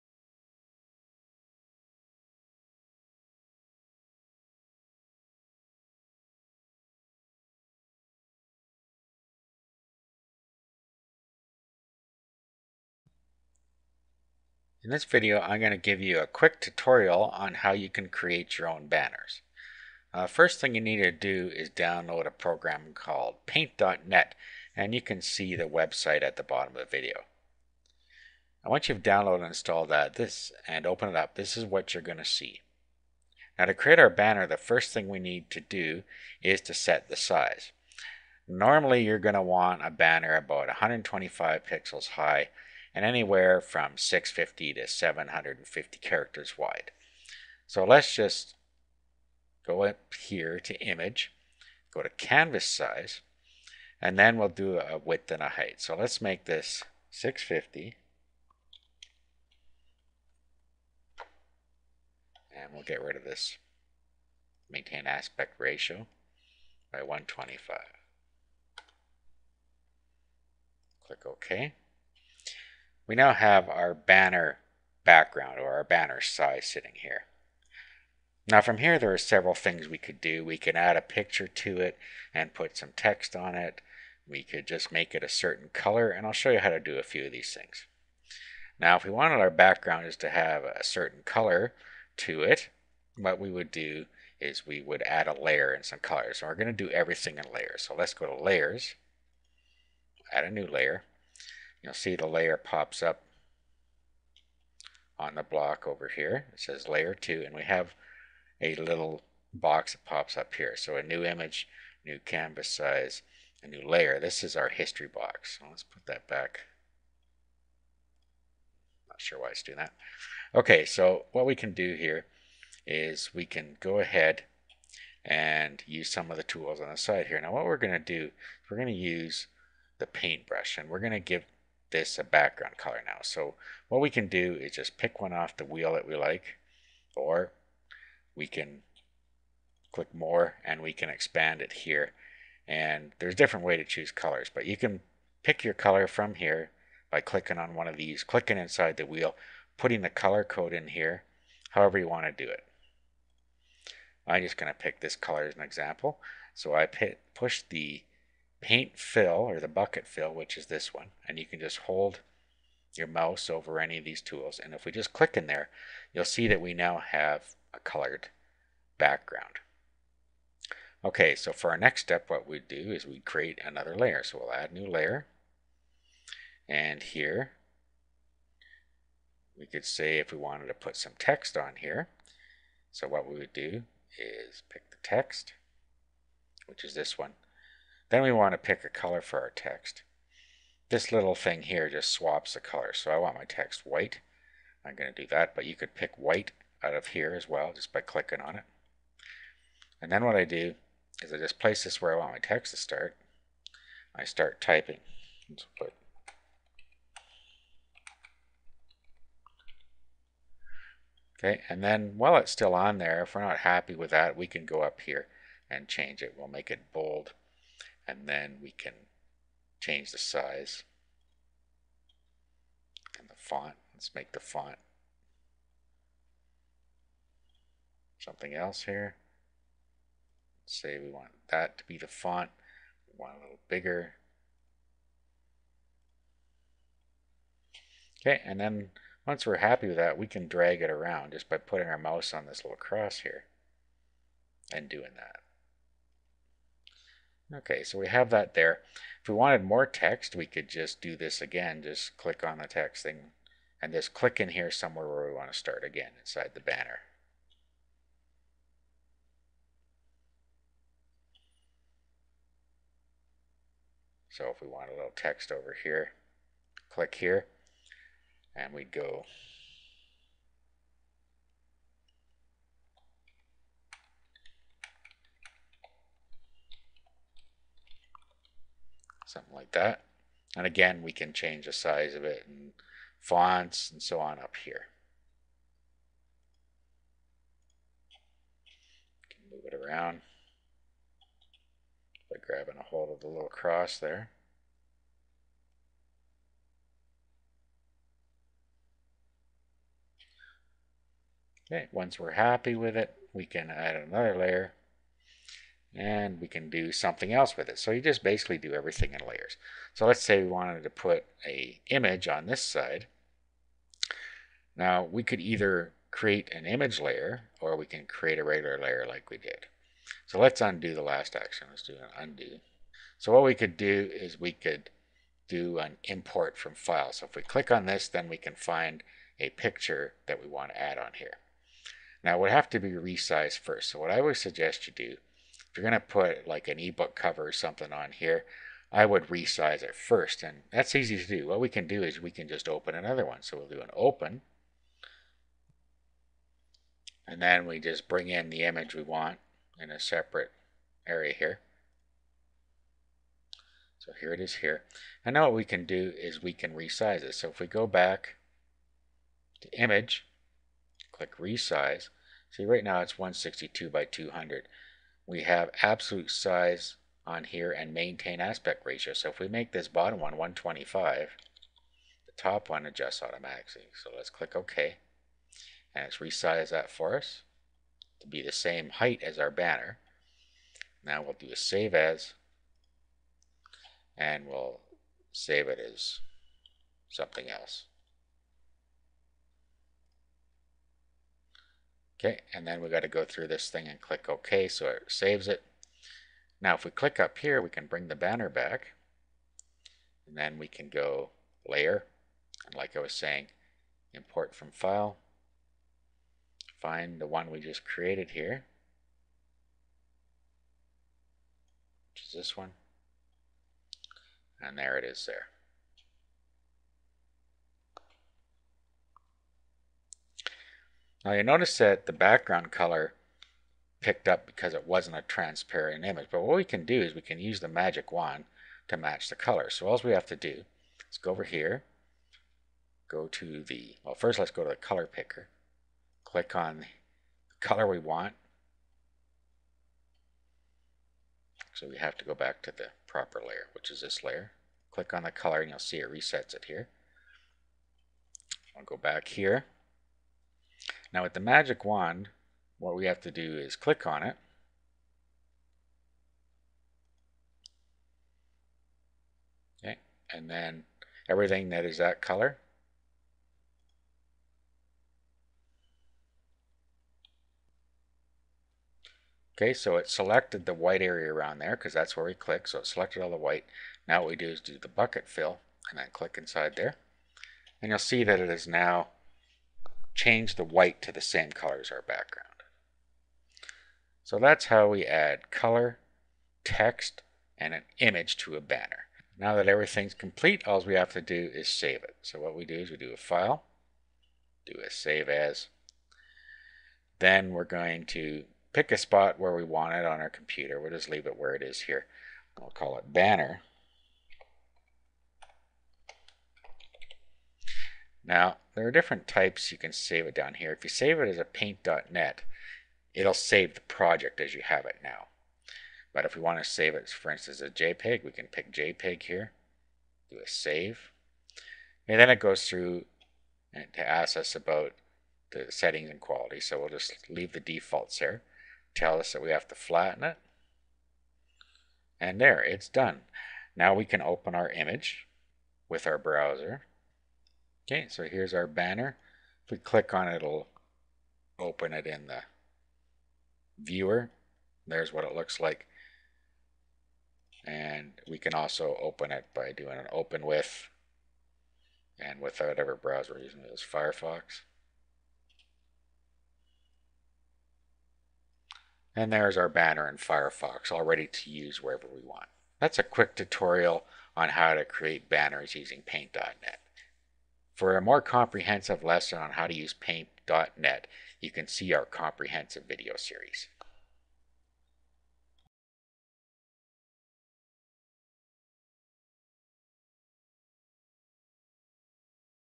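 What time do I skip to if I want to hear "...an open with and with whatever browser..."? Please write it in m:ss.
9:09.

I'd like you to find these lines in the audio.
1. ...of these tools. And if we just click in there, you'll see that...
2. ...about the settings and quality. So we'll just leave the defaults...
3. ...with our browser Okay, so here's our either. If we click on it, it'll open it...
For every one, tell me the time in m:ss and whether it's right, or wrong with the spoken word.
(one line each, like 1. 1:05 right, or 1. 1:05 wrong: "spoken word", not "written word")
1. 2:43 right
2. 8:44 right
3. 8:55 wrong: "banner", not "either".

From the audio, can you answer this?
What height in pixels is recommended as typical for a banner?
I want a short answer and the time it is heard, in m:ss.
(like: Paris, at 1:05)
125, at 0:40.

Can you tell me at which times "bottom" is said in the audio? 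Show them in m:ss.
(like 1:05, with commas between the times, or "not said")
0:26, 6:09.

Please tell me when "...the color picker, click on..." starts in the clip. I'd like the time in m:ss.
7:14.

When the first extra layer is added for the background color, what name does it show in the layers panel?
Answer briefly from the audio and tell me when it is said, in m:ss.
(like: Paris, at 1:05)
layer 2, at 1:46.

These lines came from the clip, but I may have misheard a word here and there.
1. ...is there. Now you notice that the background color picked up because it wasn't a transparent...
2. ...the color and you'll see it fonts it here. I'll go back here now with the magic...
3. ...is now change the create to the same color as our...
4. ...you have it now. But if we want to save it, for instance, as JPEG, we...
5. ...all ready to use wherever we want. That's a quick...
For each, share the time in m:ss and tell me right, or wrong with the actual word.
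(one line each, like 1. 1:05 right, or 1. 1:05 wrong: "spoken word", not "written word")
1. 6:55 right
2. 7:25 wrong: "resets", not "fonts"
3. 7:58 wrong: "white", not "create"
4. 8:34 right
5. 9:20 right.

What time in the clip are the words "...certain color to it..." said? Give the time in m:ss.
1:30.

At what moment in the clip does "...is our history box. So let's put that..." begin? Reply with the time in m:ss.
1:54.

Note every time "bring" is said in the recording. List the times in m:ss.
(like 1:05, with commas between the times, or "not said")
5:48, 6:37.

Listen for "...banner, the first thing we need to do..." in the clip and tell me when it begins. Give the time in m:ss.
0:34.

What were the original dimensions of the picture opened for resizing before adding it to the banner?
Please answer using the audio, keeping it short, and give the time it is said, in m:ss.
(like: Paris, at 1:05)
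162 by 200, at 6:03.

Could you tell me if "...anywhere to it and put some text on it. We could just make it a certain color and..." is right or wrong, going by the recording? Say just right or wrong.
wrong.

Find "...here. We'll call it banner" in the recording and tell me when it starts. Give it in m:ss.
8:21.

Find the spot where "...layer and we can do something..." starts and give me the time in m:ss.
5:04.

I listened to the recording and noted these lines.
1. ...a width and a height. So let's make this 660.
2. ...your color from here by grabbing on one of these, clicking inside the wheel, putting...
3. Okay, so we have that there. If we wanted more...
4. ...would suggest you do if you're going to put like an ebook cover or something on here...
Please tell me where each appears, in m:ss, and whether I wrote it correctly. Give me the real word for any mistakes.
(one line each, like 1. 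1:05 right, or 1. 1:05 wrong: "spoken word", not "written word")
1. 0:54 wrong: "650", not "660"
2. 2:25 wrong: "clicking", not "grabbing"
3. 4:07 right
4. 5:34 right.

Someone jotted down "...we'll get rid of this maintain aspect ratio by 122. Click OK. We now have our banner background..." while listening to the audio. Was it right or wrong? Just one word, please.
wrong.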